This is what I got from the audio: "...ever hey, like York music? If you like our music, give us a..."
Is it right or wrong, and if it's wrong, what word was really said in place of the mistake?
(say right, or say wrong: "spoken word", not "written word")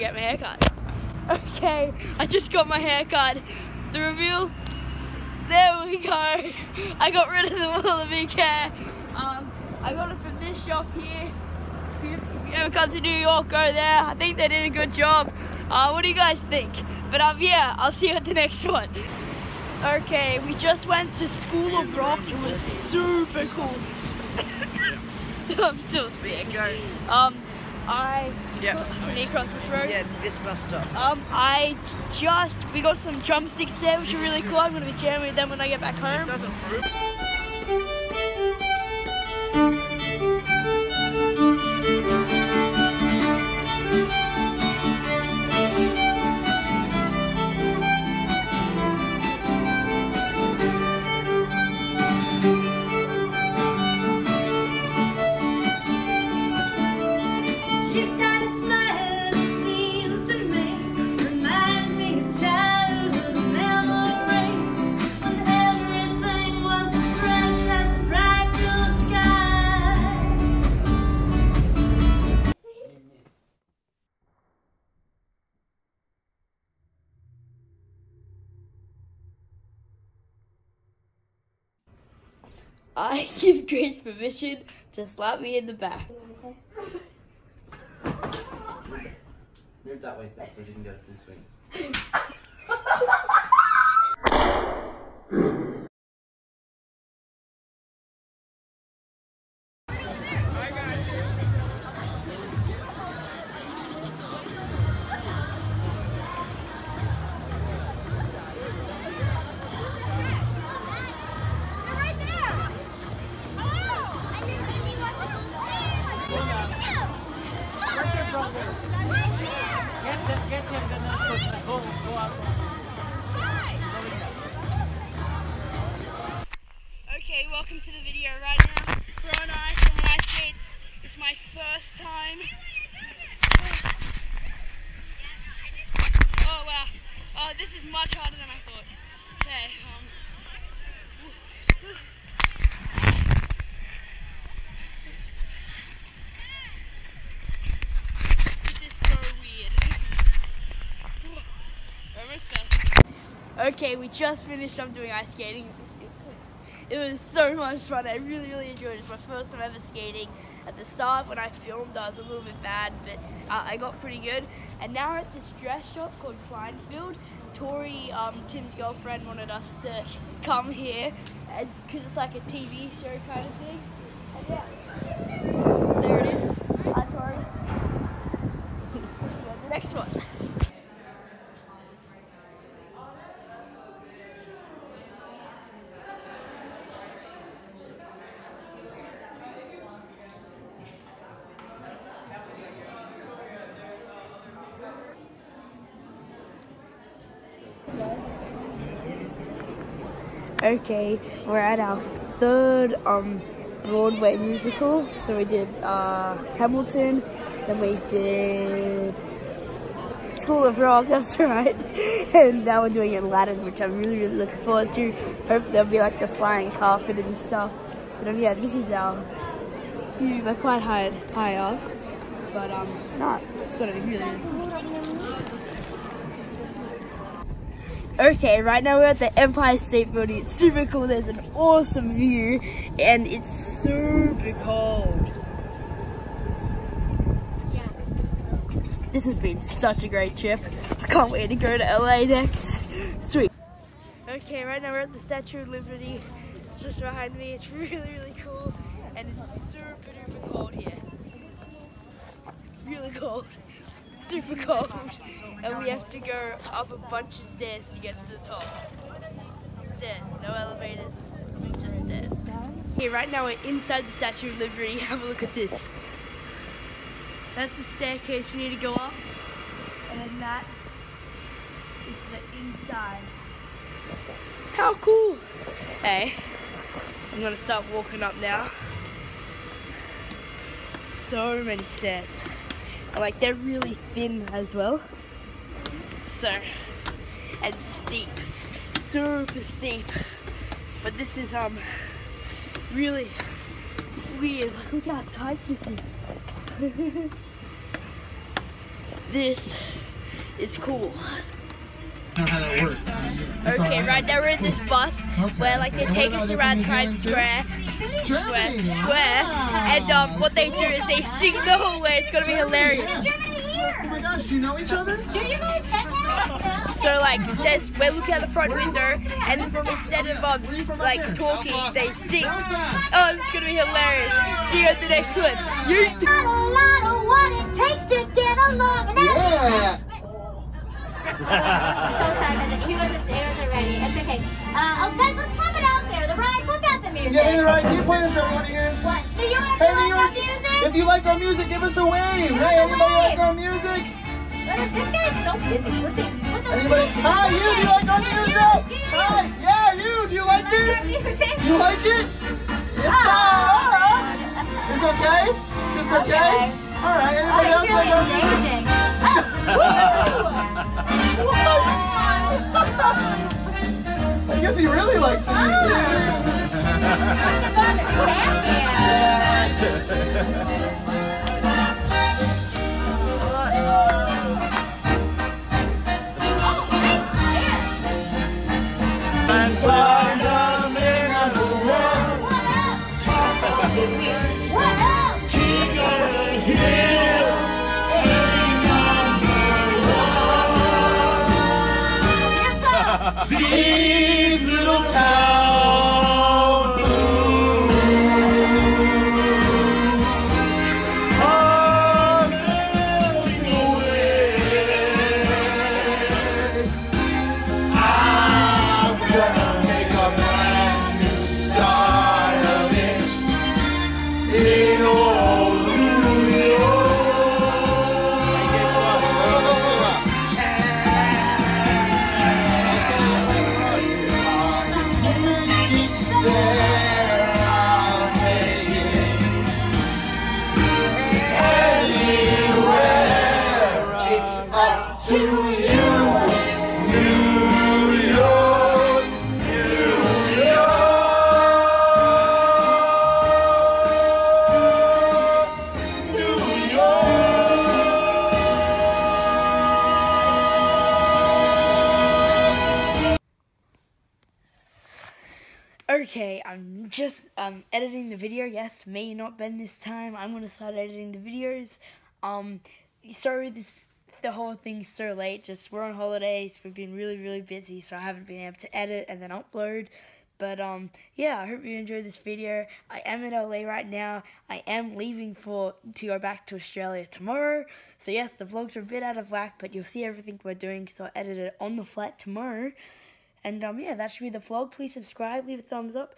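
right.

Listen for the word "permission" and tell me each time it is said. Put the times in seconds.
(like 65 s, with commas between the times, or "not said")
83 s.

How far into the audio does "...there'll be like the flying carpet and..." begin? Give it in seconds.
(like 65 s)
215 s.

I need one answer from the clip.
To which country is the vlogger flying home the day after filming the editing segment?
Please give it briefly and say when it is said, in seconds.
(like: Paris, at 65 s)
Australia, at 476 s.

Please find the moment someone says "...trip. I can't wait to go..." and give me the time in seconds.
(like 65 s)
240 s.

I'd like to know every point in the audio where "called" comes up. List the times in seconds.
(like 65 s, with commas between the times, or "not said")
166 s.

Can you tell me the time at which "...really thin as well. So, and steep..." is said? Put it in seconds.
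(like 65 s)
283 s.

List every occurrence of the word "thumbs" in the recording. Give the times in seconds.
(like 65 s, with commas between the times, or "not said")
485 s.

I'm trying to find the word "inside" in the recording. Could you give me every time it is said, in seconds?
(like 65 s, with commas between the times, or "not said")
263 s, 272 s.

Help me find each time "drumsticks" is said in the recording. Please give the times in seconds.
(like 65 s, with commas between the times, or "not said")
33 s.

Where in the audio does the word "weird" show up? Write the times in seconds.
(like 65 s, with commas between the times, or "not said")
149 s, 294 s.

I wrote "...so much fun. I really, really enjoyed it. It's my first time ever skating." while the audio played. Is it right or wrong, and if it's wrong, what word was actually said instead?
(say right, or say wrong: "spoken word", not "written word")
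right.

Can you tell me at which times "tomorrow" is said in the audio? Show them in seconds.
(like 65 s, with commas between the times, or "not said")
477 s, 482 s.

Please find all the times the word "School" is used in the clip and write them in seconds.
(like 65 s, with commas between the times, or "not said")
21 s, 210 s.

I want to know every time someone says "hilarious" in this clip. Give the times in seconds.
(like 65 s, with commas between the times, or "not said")
312 s, 323 s.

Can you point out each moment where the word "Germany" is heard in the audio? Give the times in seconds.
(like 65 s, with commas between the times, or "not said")
308 s.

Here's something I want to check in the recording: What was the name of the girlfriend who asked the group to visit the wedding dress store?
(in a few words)
Tori.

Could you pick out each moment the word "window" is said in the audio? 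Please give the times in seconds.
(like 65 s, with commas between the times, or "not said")
318 s.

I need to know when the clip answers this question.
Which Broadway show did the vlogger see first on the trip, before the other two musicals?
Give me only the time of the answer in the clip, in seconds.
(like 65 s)
206 s.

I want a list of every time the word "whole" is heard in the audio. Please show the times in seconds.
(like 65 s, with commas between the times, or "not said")
311 s, 464 s.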